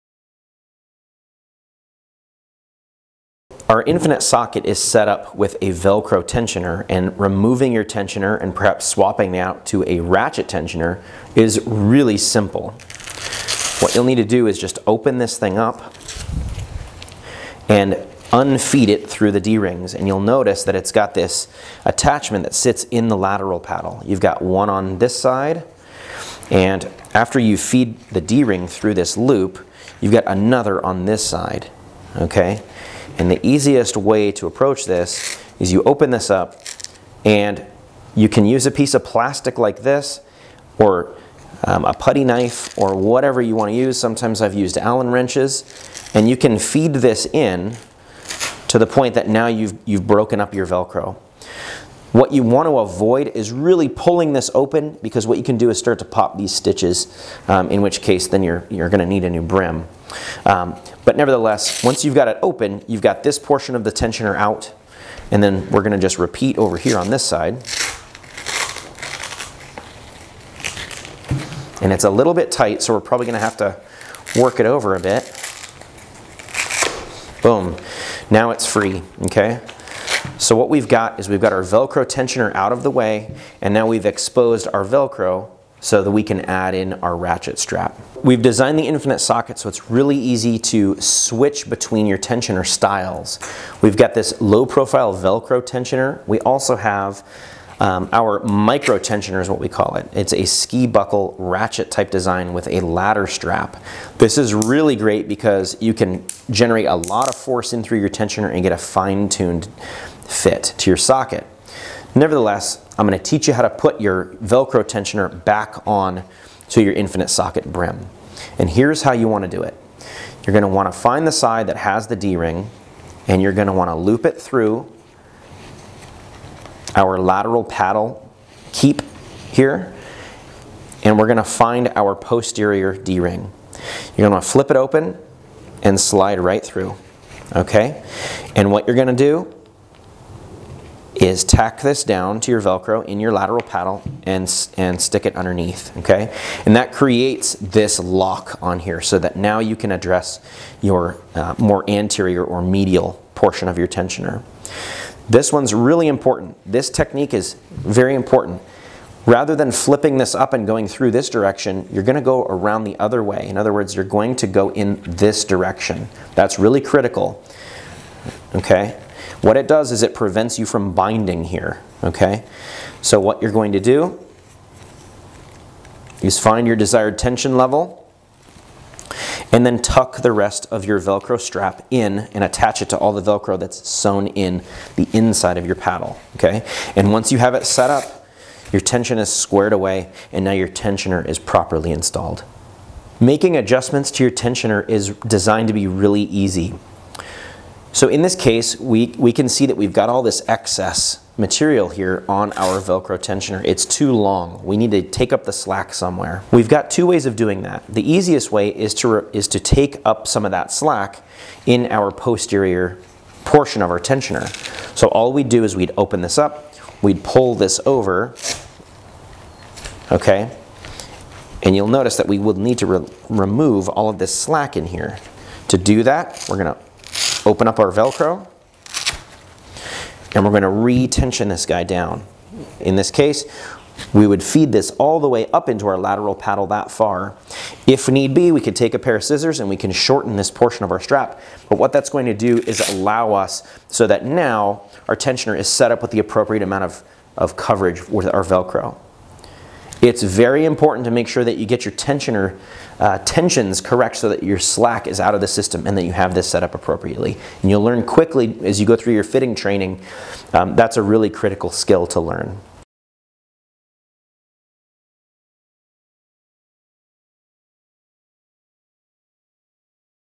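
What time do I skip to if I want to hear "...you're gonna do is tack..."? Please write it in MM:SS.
02:18.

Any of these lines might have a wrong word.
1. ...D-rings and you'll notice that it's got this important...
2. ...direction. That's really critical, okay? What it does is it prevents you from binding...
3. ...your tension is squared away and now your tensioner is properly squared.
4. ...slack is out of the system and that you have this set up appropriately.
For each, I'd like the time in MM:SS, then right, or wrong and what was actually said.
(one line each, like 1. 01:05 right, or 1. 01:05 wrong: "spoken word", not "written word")
1. 00:19 wrong: "attachment", not "important"
2. 02:45 right
3. 03:08 wrong: "installed", not "squared"
4. 04:14 right.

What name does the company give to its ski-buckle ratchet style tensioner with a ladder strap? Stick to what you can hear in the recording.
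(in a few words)
micro tensioner.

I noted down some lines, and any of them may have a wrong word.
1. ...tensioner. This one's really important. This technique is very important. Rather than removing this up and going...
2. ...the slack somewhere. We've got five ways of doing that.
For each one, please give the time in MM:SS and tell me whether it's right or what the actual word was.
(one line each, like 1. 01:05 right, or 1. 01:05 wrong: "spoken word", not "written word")
1. 02:33 wrong: "flipping", not "removing"
2. 03:25 wrong: "two", not "five".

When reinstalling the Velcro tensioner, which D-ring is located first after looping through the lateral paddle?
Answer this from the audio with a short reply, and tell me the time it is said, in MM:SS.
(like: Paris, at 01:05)
posterior D-ring, at 02:12.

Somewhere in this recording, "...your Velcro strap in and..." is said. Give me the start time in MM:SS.
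03:00.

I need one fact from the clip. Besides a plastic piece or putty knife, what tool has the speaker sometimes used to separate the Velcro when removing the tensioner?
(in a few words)
Allen wrenches.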